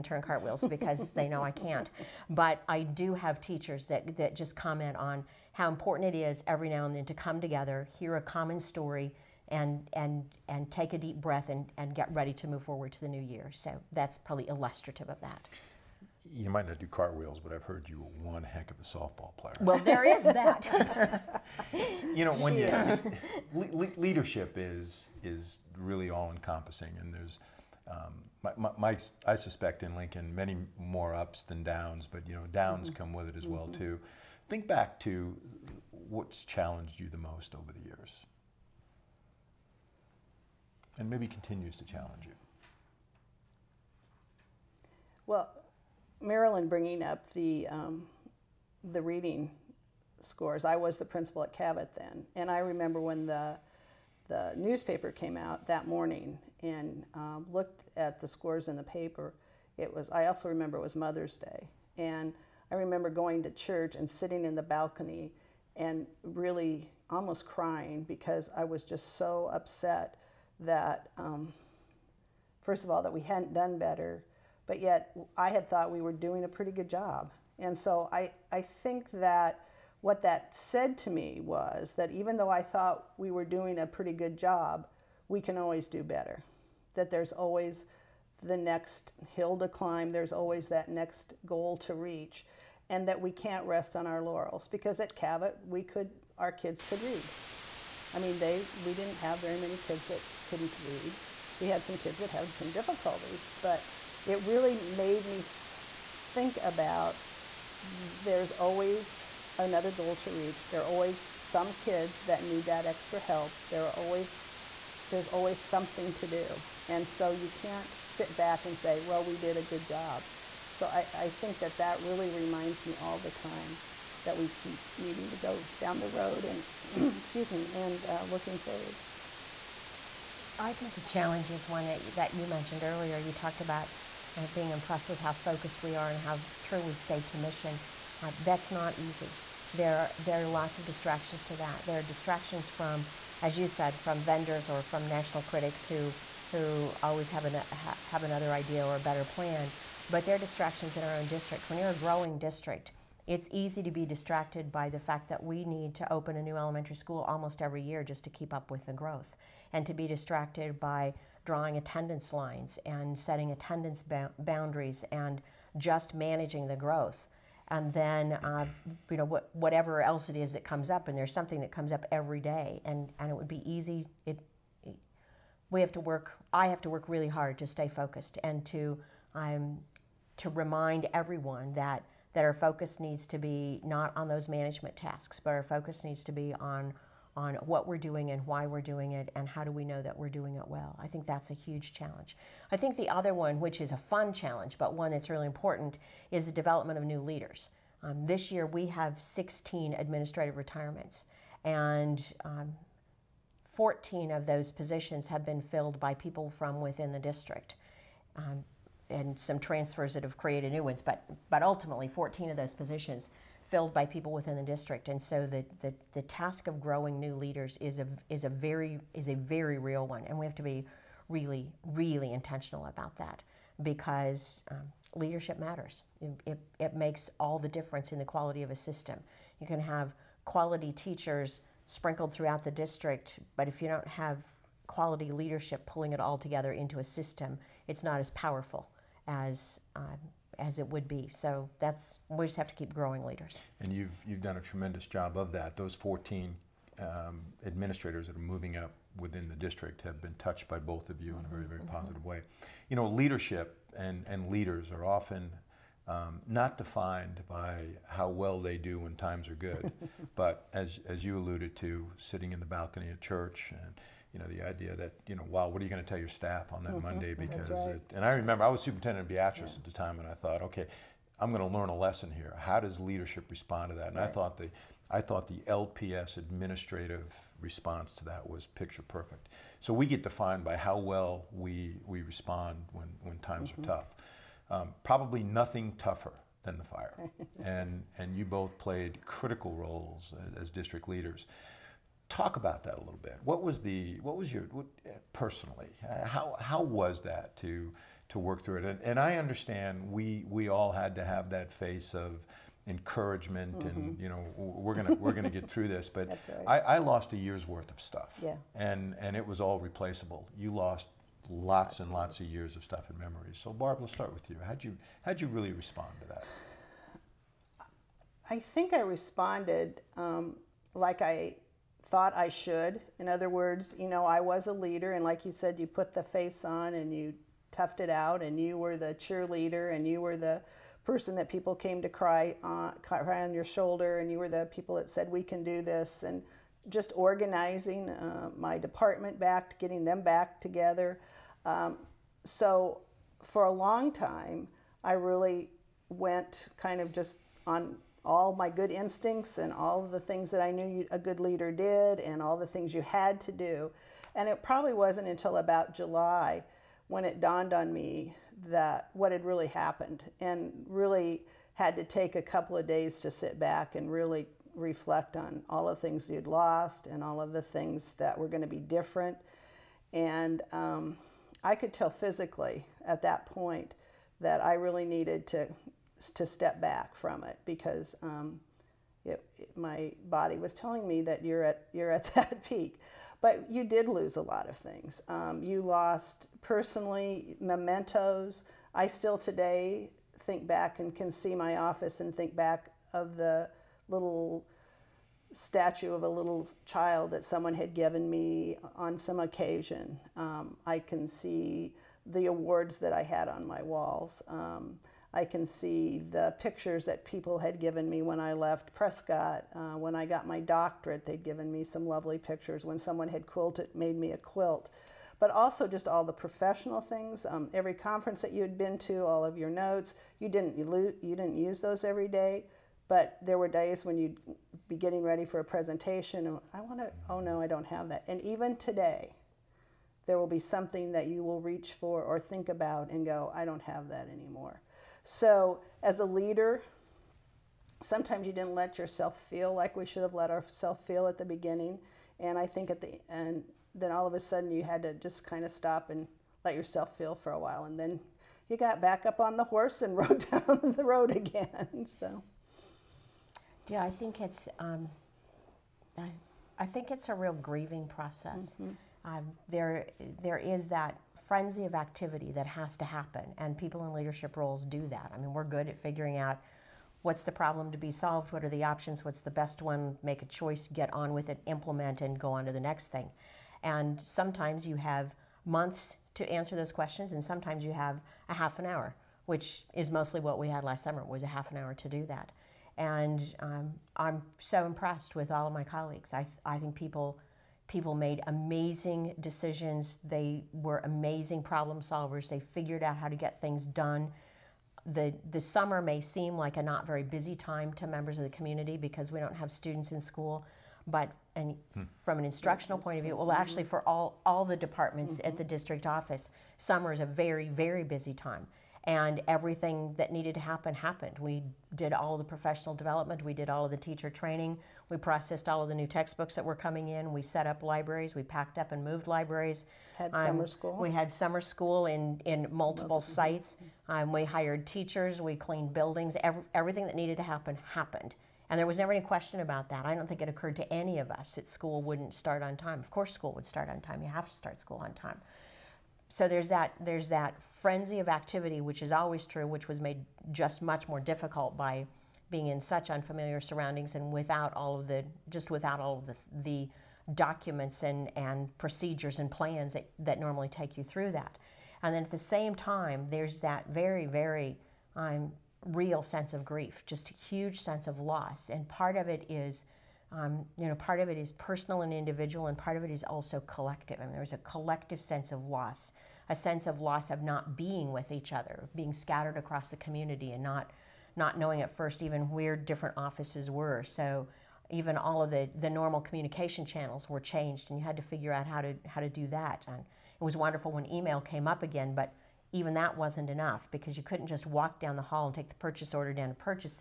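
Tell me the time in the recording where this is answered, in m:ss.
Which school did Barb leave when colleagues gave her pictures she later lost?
6:48.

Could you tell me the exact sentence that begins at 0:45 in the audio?
Well, Marilyn bringing up the, um, the reading scores, I was the principal at Cavett then.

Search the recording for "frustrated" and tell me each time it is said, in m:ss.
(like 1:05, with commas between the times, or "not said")
not said.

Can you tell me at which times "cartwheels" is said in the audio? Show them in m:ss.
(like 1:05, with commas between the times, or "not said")
0:00, 0:16.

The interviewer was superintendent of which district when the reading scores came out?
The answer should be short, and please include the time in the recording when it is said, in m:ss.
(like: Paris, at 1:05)
Beatrice, at 4:29.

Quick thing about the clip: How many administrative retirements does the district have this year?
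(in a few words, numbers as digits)
16.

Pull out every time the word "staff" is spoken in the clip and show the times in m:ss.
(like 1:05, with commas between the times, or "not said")
4:26.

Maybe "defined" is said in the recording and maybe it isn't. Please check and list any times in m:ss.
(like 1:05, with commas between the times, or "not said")
4:16, 4:40.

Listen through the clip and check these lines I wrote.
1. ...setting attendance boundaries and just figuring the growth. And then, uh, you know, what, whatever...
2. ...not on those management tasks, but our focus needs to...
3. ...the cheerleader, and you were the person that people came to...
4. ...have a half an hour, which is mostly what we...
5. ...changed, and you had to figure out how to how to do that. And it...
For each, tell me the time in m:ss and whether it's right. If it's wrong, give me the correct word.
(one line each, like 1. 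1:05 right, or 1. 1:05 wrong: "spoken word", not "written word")
1. 2:43 wrong: "managing", not "figuring"
2. 3:03 right
3. 5:28 right
4. 7:57 right
5. 9:37 right.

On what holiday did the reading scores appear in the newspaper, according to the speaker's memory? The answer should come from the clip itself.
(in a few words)
Mother's Day.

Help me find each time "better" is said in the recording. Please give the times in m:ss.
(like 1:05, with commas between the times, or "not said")
1:13, 1:26, 2:28.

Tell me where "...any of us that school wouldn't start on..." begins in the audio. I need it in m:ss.
8:50.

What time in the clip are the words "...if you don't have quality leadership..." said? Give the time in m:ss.
3:53.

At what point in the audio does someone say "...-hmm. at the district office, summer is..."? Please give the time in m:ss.
8:25.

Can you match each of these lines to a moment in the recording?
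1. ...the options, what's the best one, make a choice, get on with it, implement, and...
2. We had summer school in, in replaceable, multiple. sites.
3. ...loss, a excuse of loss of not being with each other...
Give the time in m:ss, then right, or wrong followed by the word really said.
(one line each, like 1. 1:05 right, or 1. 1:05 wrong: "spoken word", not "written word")
1. 7:48 right
2. 8:40 wrong: "multiple", not "replaceable"
3. 9:25 wrong: "sense", not "excuse".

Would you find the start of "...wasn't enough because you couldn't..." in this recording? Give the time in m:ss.
9:43.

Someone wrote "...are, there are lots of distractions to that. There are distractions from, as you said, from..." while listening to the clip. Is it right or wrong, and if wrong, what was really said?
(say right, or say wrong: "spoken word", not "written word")
right.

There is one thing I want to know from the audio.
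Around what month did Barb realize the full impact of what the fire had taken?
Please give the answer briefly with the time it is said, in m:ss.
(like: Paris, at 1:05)
July, at 5:55.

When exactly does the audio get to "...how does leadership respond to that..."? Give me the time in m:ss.
4:32.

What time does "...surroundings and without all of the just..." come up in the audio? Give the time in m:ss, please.
9:03.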